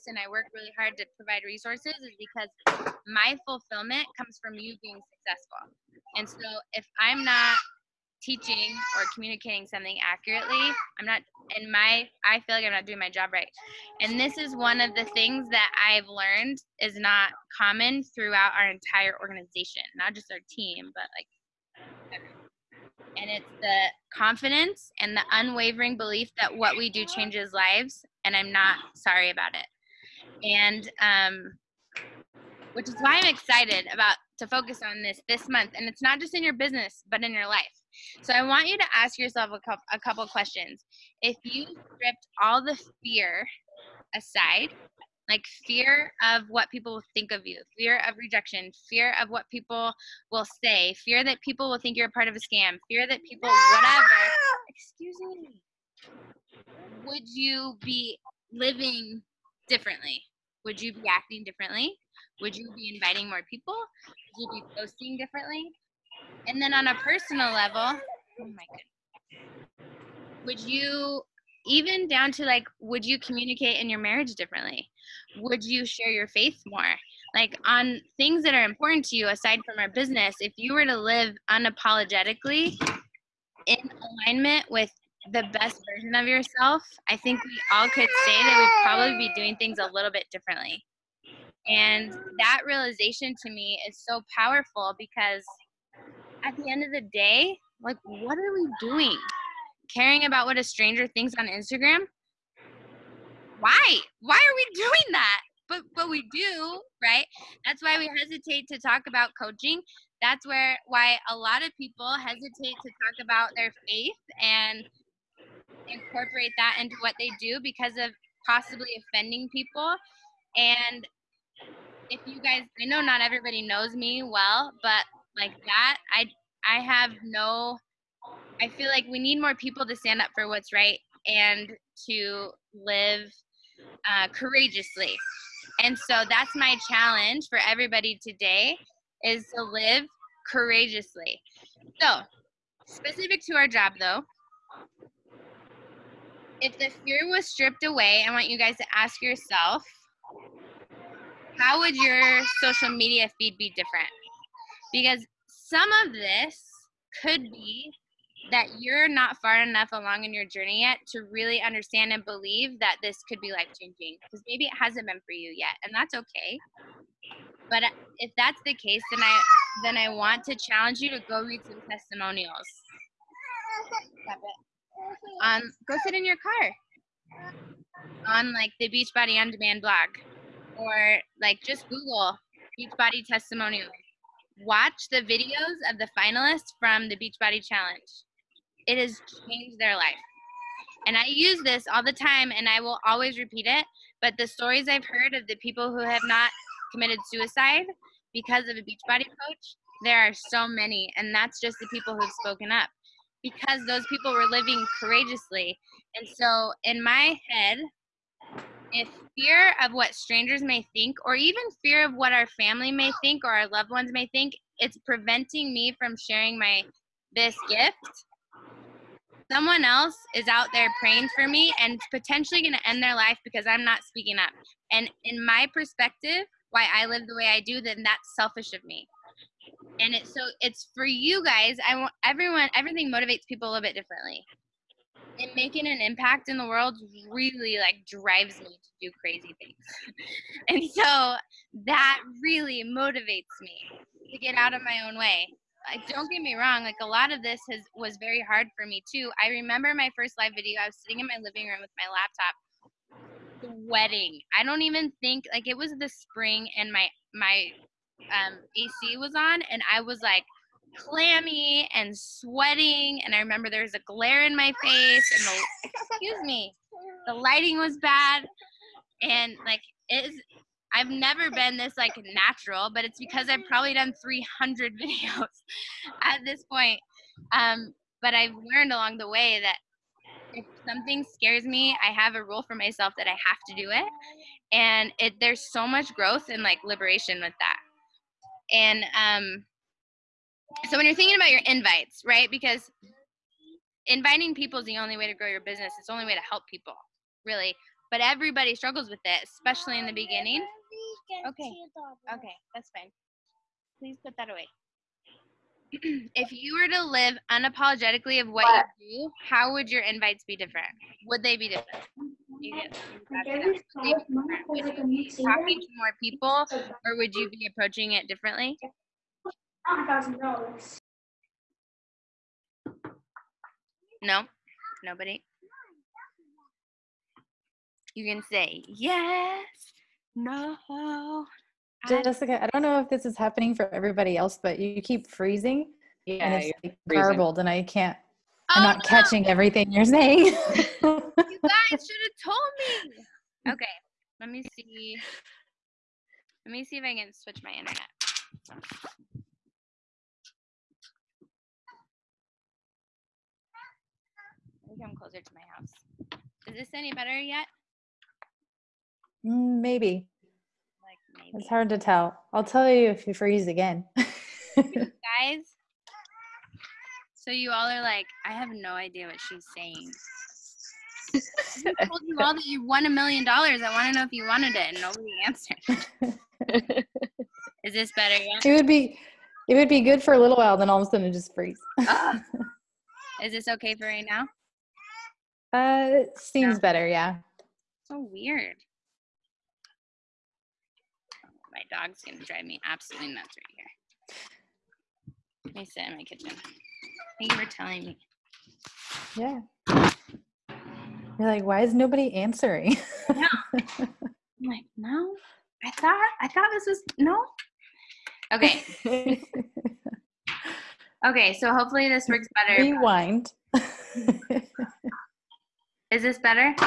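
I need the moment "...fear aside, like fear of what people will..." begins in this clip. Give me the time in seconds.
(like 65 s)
43 s.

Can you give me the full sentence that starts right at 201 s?
And that's just the people who've spoken up because those people were living courageously.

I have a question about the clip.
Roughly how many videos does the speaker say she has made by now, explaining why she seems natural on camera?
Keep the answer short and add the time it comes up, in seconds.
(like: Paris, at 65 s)
300, at 274 s.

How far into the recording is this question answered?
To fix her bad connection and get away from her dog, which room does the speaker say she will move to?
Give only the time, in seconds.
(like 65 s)
396 s.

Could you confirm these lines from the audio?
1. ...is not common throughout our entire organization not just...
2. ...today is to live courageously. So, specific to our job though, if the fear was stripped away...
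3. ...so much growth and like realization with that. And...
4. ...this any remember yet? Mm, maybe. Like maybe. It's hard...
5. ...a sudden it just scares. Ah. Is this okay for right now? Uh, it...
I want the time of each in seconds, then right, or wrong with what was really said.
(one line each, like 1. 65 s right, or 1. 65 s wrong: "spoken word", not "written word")
1. 16 s right
2. 138 s right
3. 285 s wrong: "liberation", not "realization"
4. 356 s wrong: "better", not "remember"
5. 381 s wrong: "freezes", not "scares".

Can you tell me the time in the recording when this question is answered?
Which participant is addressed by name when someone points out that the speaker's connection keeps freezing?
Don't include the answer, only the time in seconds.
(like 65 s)
332 s.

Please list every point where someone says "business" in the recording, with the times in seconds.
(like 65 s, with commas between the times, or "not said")
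36 s, 79 s, 295 s.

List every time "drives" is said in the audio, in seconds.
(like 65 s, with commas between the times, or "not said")
238 s, 392 s.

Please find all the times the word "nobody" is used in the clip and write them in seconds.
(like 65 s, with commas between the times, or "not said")
325 s, 375 s, 401 s.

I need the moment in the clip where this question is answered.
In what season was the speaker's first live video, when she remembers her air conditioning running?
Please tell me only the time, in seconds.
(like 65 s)
256 s.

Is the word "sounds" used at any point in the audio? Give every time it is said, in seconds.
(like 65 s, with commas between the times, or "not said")
not said.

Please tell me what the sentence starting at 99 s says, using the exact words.
Caring about what a stranger thinks on Instagram?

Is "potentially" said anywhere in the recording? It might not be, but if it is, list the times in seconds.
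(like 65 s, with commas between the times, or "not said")
222 s.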